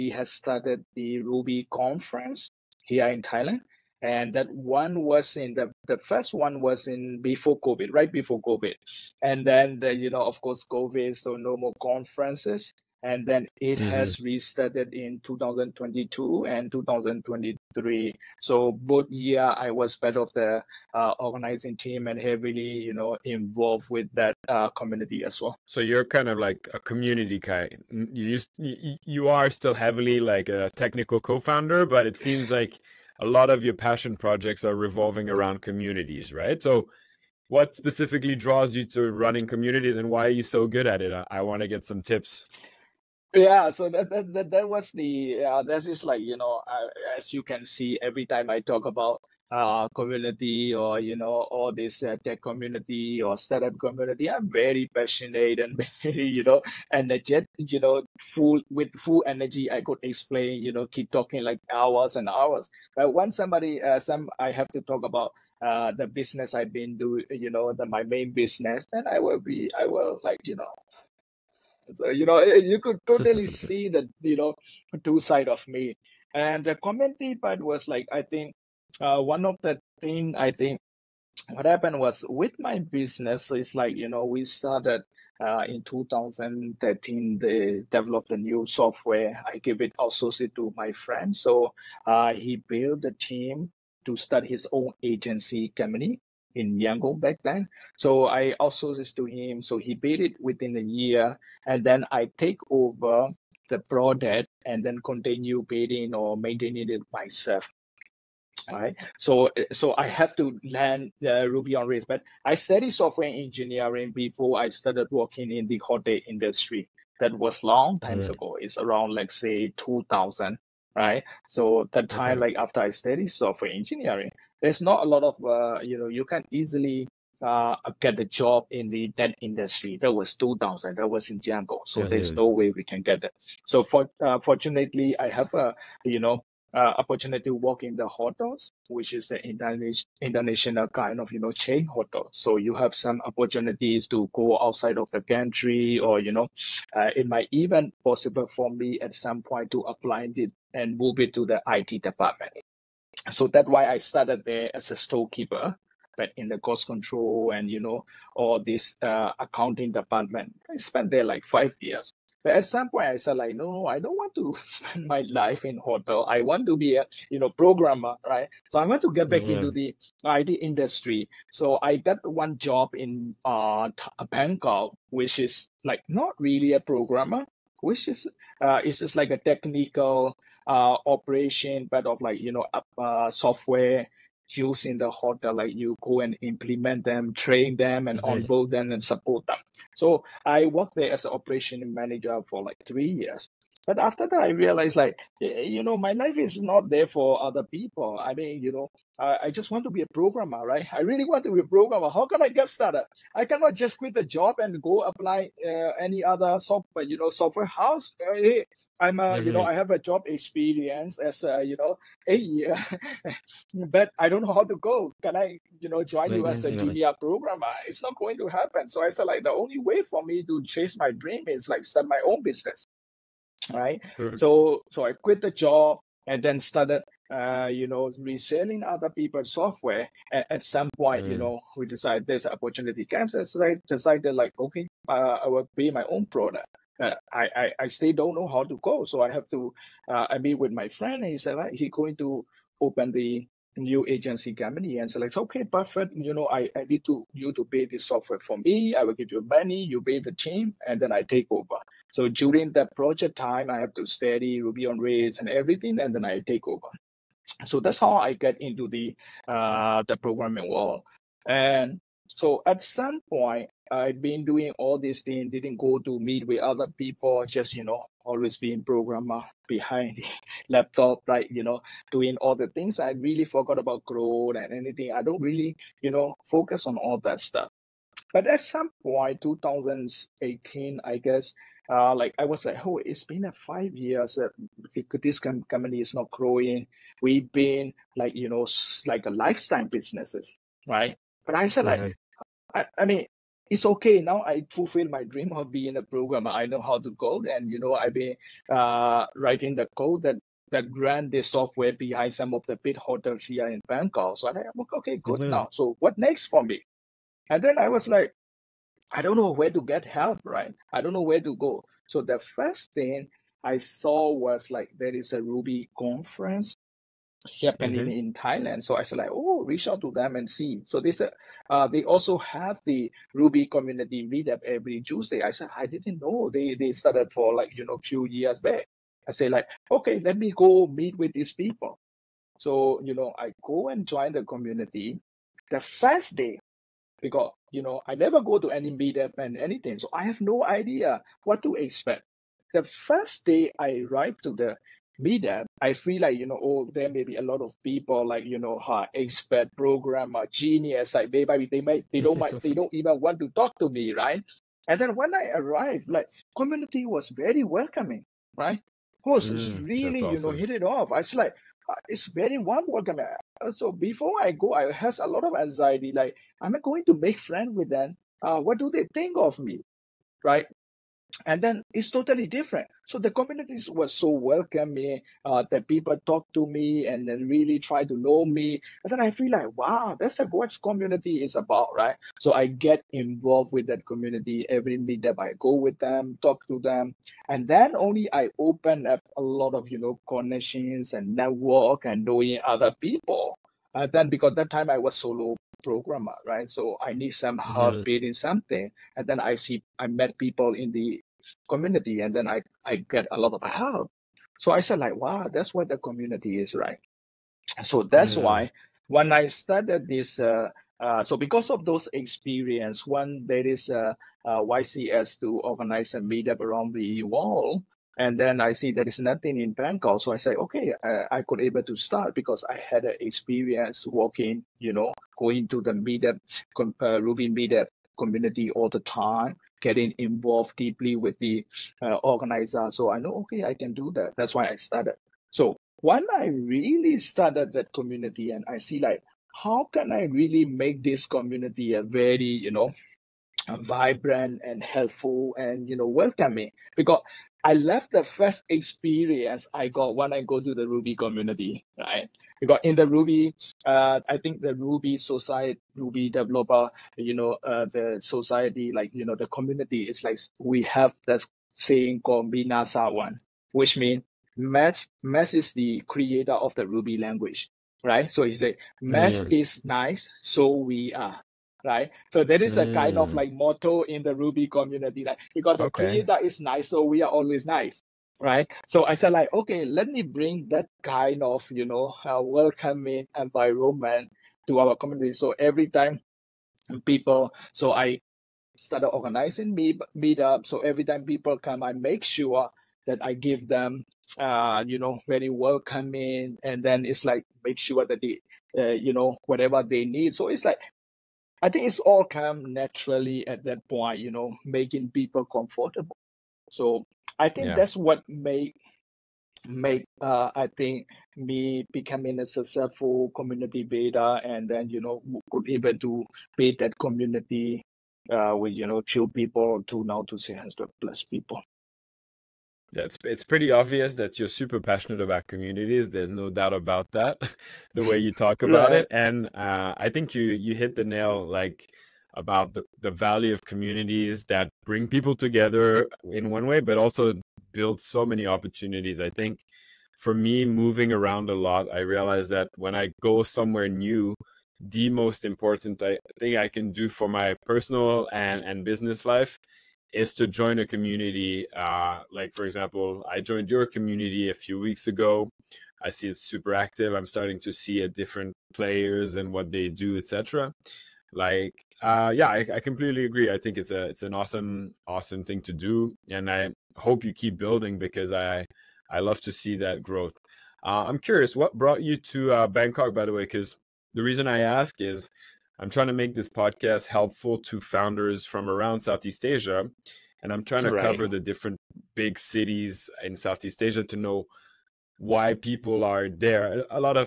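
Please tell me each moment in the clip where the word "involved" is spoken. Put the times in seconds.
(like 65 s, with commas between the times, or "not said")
23 s, 383 s, 430 s.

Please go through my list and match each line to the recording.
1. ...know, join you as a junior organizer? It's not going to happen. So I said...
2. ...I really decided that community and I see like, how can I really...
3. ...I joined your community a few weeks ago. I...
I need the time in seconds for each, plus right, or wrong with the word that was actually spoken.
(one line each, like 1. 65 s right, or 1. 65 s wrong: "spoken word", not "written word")
1. 215 s wrong: "programmer", not "organizer"
2. 436 s wrong: "started", not "decided"
3. 553 s right.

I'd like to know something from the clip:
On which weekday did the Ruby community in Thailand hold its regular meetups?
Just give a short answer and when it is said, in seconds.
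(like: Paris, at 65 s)
Tuesday, at 325 s.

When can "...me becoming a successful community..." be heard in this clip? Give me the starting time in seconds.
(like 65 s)
511 s.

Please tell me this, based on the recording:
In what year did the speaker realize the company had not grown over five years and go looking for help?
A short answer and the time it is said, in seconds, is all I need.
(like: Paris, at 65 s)
2018, at 279 s.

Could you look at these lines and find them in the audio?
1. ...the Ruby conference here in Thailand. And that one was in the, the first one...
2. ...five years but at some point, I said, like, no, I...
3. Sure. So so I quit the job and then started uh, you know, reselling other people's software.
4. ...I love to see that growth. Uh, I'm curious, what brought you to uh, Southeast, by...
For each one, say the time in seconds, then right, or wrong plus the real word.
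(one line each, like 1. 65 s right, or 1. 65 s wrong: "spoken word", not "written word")
1. 0 s right
2. 161 s right
3. 224 s right
4. 569 s wrong: "Bangkok", not "Southeast".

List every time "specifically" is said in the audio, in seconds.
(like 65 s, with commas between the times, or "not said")
37 s.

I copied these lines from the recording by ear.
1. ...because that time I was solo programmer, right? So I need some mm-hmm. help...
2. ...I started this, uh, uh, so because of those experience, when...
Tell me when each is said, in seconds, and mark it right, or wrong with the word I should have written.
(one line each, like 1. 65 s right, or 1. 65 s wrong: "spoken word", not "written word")
1. 394 s right
2. 409 s right.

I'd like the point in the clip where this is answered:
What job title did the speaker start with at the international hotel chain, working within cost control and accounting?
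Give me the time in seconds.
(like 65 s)
154 s.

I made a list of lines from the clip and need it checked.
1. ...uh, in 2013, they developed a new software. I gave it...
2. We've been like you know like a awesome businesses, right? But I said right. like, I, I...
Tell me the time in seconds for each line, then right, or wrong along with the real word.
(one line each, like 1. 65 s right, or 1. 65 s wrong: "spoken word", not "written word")
1. 85 s right
2. 287 s wrong: "lifetime", not "awesome".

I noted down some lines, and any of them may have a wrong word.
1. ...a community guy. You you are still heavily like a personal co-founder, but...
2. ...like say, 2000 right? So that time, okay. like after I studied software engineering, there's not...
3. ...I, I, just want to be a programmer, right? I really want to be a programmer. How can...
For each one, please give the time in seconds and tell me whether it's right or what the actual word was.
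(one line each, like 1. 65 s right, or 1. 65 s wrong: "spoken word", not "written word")
1. 26 s wrong: "technical", not "personal"
2. 119 s right
3. 199 s right.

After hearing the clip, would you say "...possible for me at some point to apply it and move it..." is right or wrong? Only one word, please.
right.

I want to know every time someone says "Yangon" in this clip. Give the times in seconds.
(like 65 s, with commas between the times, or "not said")
96 s, 131 s.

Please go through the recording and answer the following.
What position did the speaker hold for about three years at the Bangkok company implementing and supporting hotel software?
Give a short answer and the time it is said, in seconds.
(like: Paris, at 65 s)
Operation manager, at 191 s.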